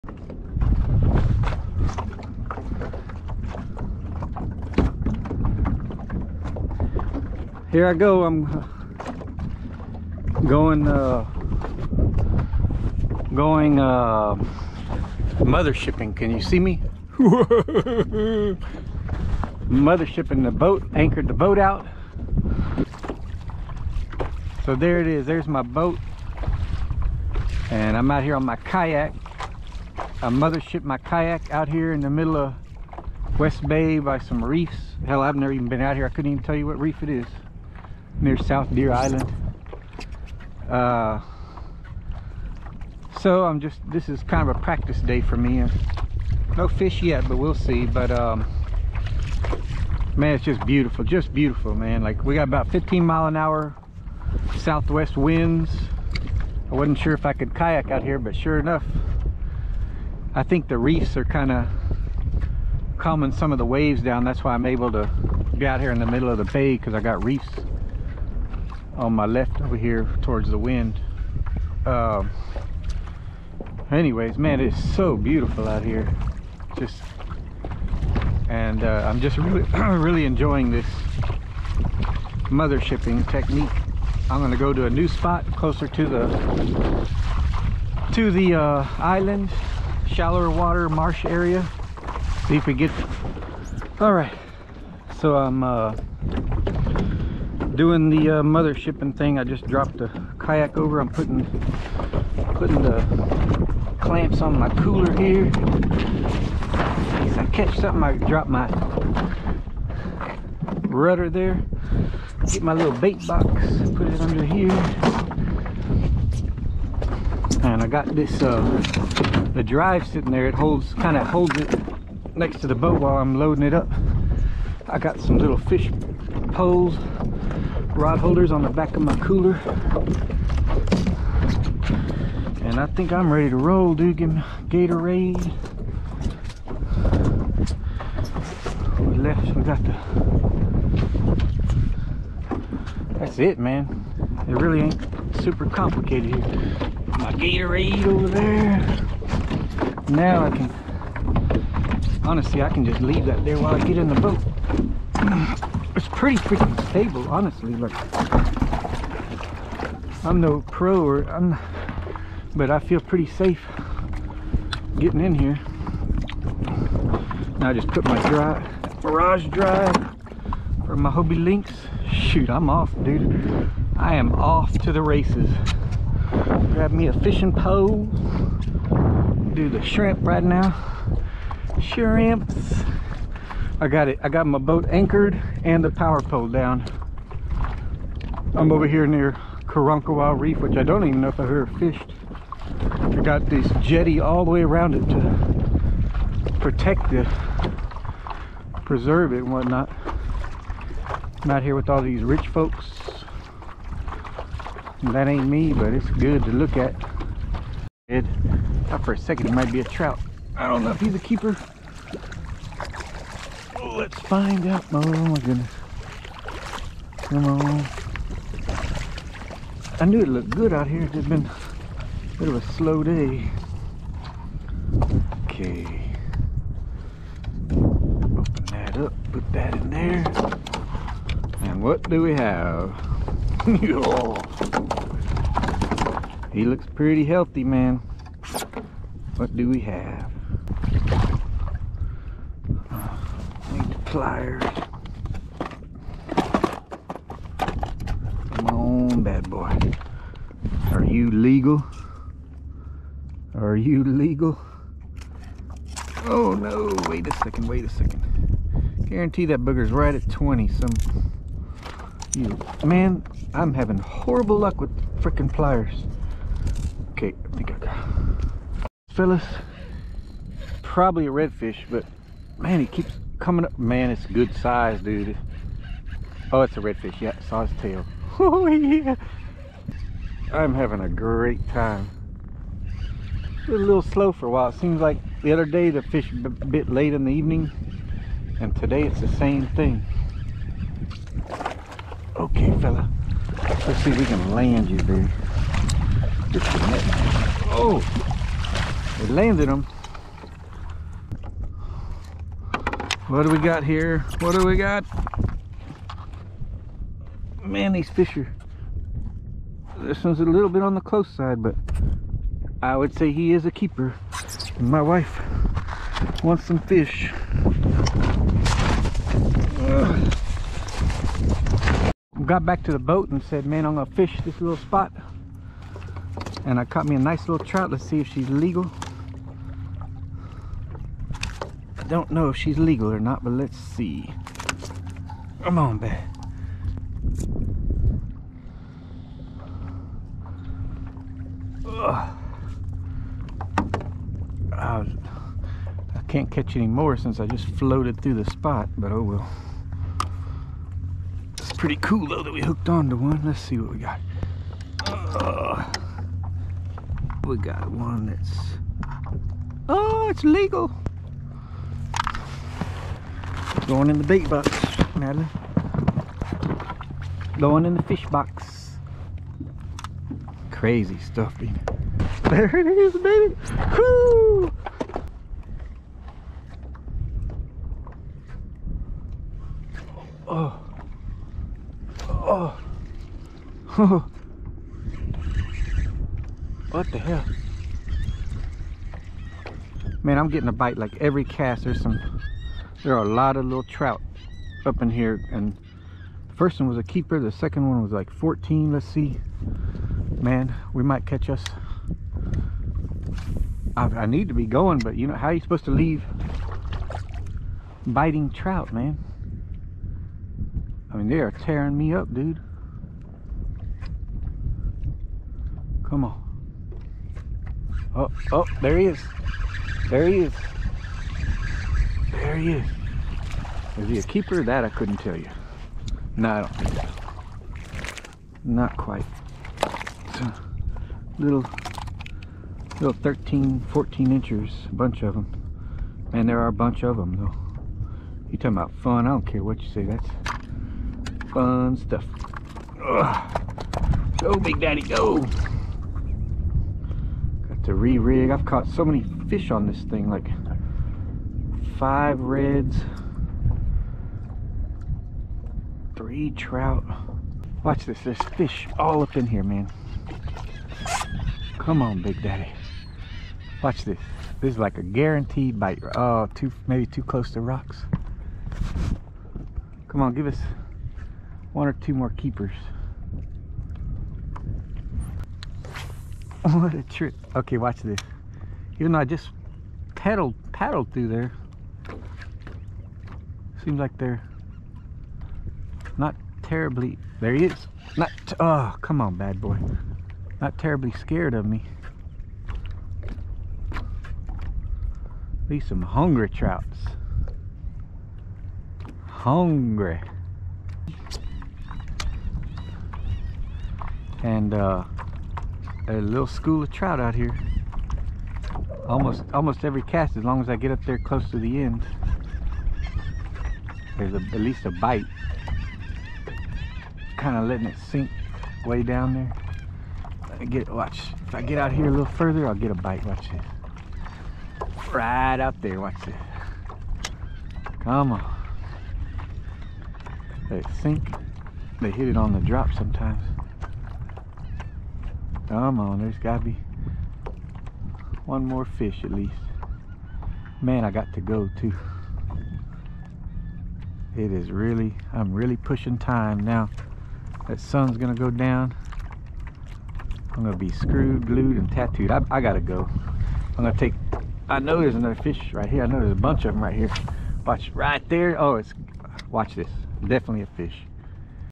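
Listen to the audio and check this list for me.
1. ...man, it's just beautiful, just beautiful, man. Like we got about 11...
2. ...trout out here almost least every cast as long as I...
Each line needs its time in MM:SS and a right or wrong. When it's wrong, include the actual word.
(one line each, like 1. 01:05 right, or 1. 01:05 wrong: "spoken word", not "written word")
1. 00:50 wrong: "15", not "11"
2. 08:26 wrong: "almost", not "least".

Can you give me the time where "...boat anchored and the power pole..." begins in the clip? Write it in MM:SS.
03:04.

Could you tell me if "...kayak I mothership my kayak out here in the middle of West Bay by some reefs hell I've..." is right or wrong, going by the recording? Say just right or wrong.
right.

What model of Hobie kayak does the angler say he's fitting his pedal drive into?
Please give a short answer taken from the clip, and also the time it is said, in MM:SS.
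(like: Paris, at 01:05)
Hobie Lynx, at 02:51.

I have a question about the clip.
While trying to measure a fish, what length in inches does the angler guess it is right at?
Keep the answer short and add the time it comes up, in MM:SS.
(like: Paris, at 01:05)
20, at 04:20.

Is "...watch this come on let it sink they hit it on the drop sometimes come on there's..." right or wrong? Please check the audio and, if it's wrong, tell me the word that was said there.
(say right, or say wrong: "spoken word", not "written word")
right.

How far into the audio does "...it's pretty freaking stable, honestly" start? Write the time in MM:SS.
02:35.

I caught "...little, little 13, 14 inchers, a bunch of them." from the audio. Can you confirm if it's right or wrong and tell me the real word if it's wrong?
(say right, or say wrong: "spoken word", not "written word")
right.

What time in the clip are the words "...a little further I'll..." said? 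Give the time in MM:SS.
08:42.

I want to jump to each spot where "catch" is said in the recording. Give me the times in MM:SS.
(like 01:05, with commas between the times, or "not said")
01:47, 05:46, 06:41.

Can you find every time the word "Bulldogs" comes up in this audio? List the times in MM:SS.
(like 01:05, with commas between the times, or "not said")
not said.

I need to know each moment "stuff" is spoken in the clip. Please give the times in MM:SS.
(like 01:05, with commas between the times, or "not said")
06:11, 07:21.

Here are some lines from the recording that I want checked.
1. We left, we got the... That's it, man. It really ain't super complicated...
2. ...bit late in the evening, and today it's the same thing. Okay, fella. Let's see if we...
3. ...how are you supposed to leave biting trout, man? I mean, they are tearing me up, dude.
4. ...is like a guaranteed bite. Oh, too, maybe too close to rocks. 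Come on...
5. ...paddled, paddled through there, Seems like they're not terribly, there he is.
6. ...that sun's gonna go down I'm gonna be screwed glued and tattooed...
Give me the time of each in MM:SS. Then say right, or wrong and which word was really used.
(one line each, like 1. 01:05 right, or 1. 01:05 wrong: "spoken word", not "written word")
1. 02:18 right
2. 04:46 right
3. 06:45 right
4. 07:44 right
5. 08:00 right
6. 09:07 right.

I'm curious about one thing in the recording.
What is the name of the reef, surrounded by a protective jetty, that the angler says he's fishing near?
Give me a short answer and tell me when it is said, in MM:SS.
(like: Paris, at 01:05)
Carancahua Reef, at 03:09.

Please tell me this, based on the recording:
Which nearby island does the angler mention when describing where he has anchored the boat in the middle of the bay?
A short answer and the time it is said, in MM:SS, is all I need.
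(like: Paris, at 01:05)
South Deer Island, at 00:38.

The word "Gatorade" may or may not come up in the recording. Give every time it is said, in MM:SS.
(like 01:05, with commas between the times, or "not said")
02:14, 02:27.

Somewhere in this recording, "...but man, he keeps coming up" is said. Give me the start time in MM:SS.
04:31.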